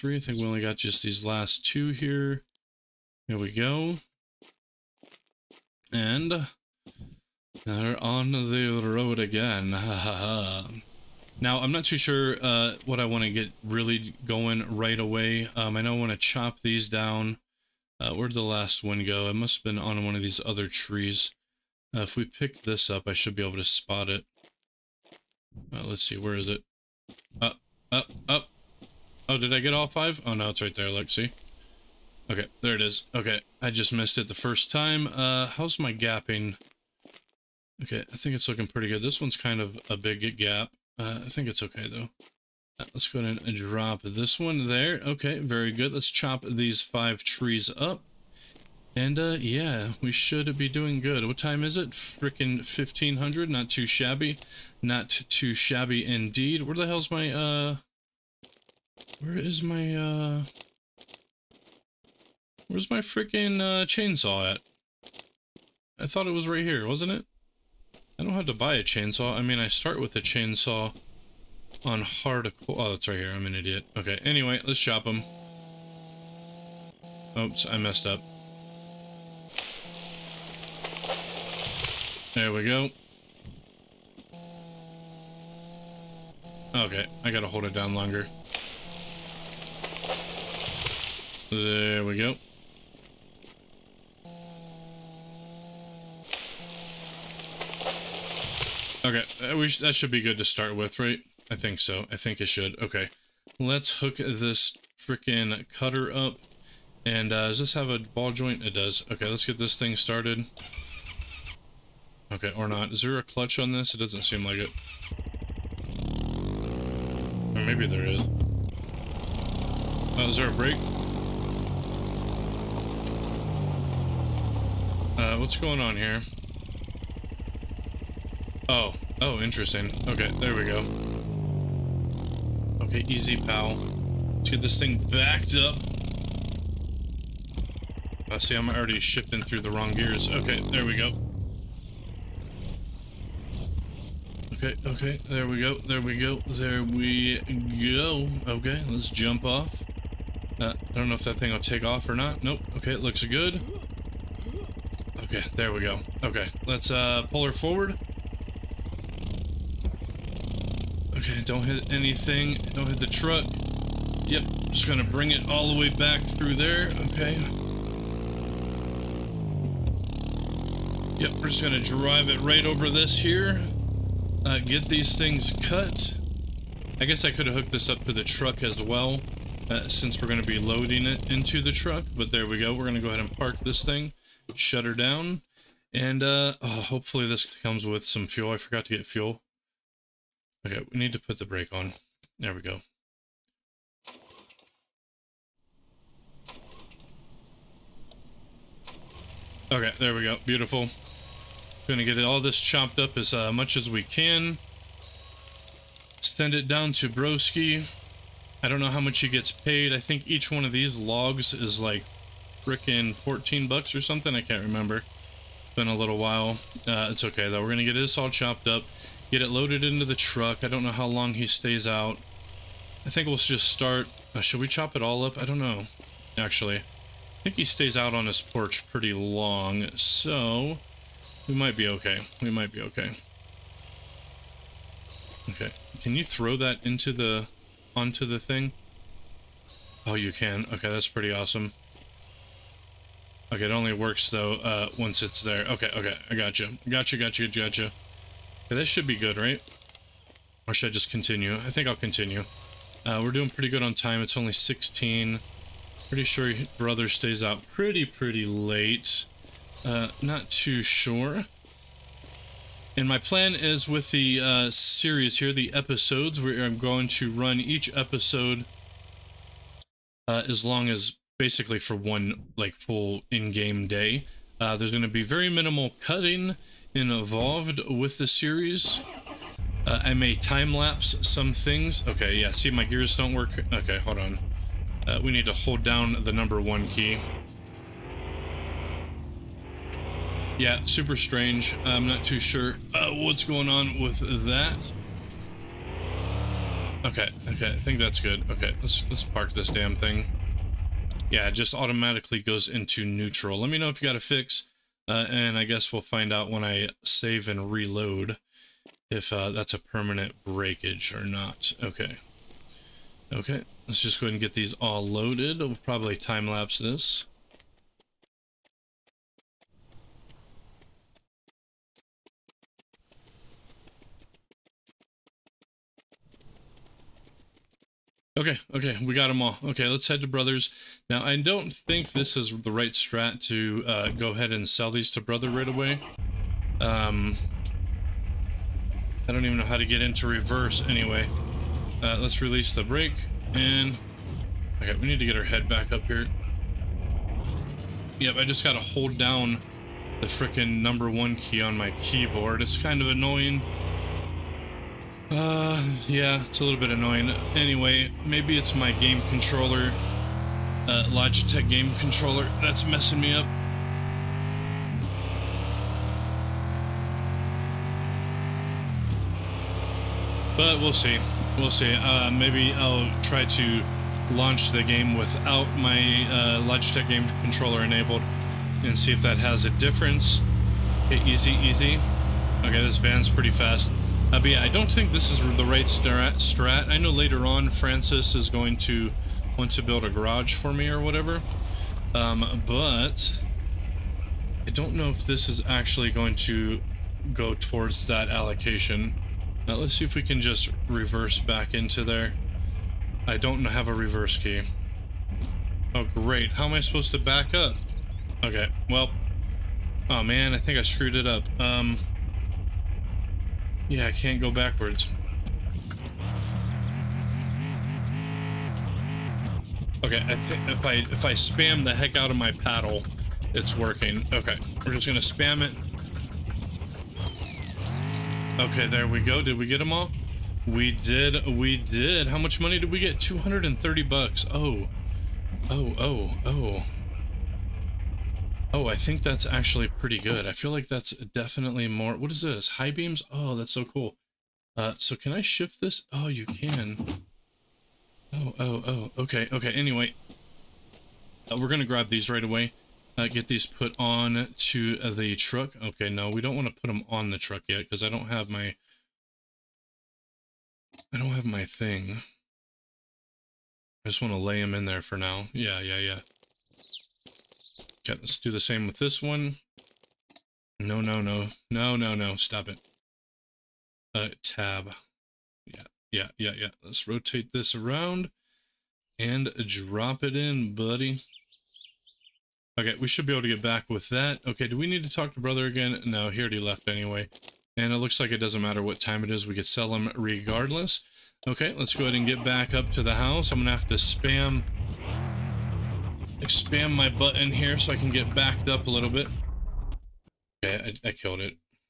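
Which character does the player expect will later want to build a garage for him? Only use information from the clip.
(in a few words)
Francis.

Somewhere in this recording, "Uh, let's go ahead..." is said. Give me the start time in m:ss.
0:42.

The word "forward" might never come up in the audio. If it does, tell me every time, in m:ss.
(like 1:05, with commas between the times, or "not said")
2:37.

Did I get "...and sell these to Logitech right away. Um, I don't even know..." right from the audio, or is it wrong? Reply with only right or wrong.
wrong.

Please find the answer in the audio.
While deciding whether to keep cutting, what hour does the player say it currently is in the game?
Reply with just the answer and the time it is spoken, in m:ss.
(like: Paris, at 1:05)
16, at 4:14.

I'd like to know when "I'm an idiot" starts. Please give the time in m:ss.
1:13.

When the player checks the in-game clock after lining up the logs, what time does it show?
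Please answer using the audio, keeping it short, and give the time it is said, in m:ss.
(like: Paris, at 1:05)
1500, at 0:52.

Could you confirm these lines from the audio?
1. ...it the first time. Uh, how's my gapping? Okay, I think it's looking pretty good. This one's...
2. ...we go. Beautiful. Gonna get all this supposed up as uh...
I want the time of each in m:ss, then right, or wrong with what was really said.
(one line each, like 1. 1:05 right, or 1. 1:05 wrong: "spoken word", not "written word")
1. 0:34 right
2. 3:20 wrong: "chopped", not "supposed".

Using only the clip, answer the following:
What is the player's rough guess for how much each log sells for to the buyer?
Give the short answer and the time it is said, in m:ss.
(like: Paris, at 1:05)
14 bucks, at 3:33.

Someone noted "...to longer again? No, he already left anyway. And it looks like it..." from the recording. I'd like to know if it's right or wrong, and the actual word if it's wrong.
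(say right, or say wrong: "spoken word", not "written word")
wrong: "brother", not "longer".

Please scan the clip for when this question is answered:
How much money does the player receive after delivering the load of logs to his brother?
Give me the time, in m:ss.
7:13.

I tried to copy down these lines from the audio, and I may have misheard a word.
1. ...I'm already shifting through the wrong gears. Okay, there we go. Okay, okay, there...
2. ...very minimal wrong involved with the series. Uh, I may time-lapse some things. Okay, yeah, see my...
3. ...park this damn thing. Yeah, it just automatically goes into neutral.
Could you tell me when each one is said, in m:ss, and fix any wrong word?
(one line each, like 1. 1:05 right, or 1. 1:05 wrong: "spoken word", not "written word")
1. 2:18 right
2. 4:35 wrong: "cutting", not "wrong"
3. 4:59 right.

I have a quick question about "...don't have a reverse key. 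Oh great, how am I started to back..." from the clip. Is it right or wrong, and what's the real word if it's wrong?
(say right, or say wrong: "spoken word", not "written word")
wrong: "supposed", not "started".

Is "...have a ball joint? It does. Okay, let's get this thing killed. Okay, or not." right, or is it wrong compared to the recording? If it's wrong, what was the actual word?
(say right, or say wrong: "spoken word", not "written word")
wrong: "started", not "killed".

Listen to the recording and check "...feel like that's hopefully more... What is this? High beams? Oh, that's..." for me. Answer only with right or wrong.
wrong.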